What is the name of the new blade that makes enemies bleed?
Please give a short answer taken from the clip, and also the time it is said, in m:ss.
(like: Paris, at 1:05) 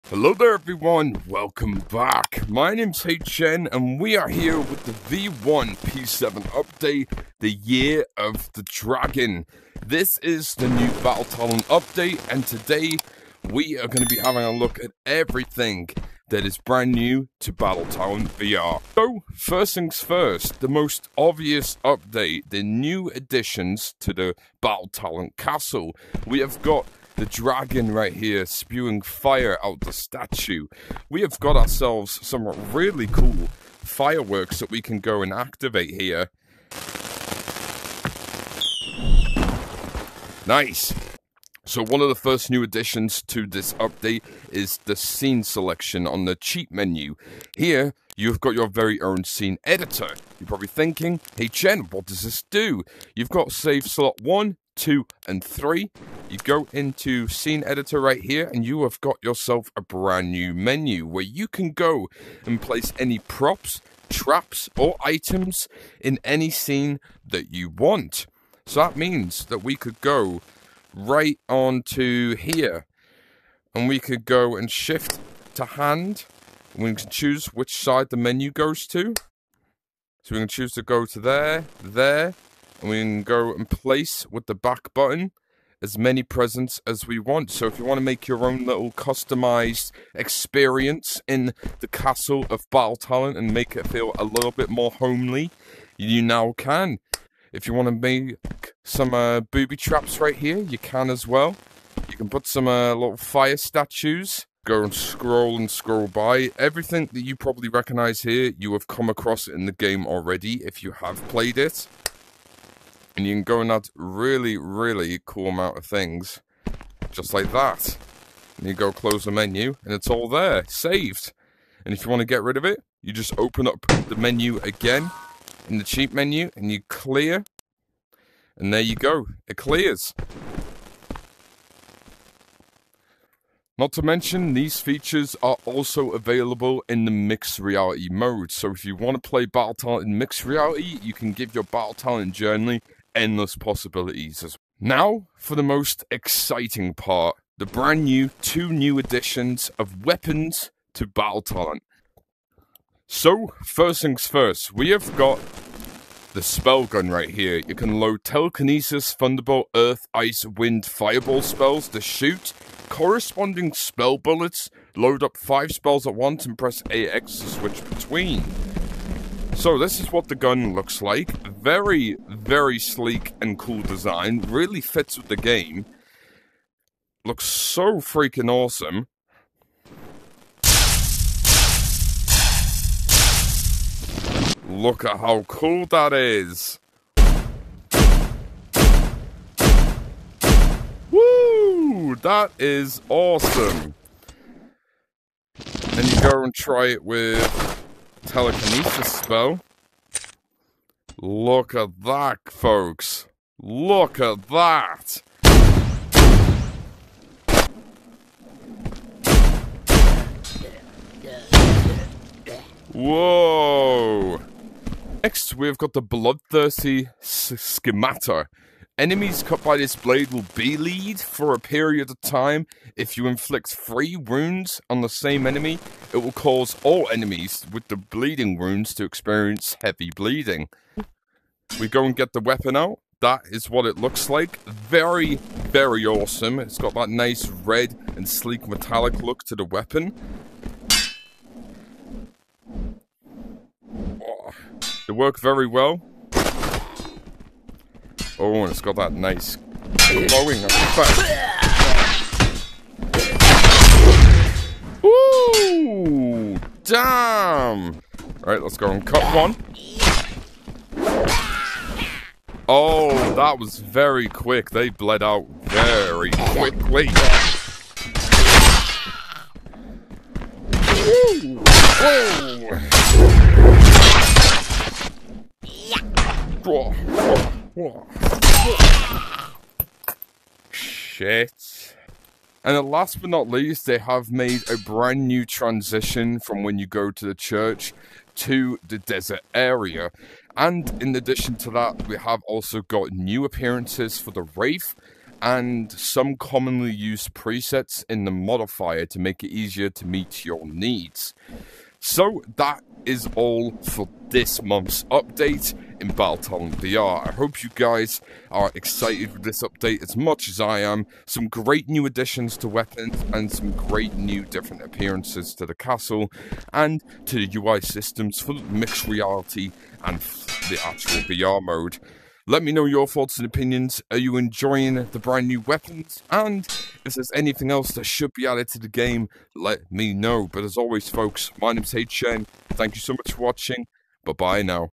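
Bloodthirsty scimitar, at 3:36.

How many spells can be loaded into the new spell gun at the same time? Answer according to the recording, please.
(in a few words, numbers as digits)
5.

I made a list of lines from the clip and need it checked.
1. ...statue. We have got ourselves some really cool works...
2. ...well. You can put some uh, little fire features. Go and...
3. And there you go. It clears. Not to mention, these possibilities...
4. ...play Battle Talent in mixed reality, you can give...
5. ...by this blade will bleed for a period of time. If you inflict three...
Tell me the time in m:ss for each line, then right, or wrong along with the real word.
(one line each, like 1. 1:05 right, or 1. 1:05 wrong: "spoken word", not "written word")
1. 0:29 wrong: "fireworks", not "works"
2. 1:41 wrong: "statues", not "features"
3. 2:08 wrong: "features", not "possibilities"
4. 2:19 right
5. 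3:39 right.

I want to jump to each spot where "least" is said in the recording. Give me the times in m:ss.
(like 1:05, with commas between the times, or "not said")
4:43.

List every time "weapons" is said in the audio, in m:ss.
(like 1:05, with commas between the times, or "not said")
2:30, 3:52, 3:59, 5:12, 5:25.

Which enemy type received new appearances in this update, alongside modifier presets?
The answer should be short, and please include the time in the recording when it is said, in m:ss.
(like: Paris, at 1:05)
Wraith, at 4:54.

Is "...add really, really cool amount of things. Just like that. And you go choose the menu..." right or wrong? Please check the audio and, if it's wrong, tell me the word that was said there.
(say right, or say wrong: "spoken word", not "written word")
wrong: "close", not "choose".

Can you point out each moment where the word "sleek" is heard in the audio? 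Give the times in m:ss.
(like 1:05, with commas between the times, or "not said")
2:52, 3:58.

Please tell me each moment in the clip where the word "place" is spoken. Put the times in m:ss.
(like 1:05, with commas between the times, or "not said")
1:02, 1:23.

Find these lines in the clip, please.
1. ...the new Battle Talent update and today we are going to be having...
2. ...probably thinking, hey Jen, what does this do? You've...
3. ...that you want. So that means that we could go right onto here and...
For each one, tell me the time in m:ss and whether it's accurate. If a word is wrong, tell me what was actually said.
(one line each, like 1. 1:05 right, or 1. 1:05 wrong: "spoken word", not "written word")
1. 0:10 right
2. 0:50 right
3. 1:07 right.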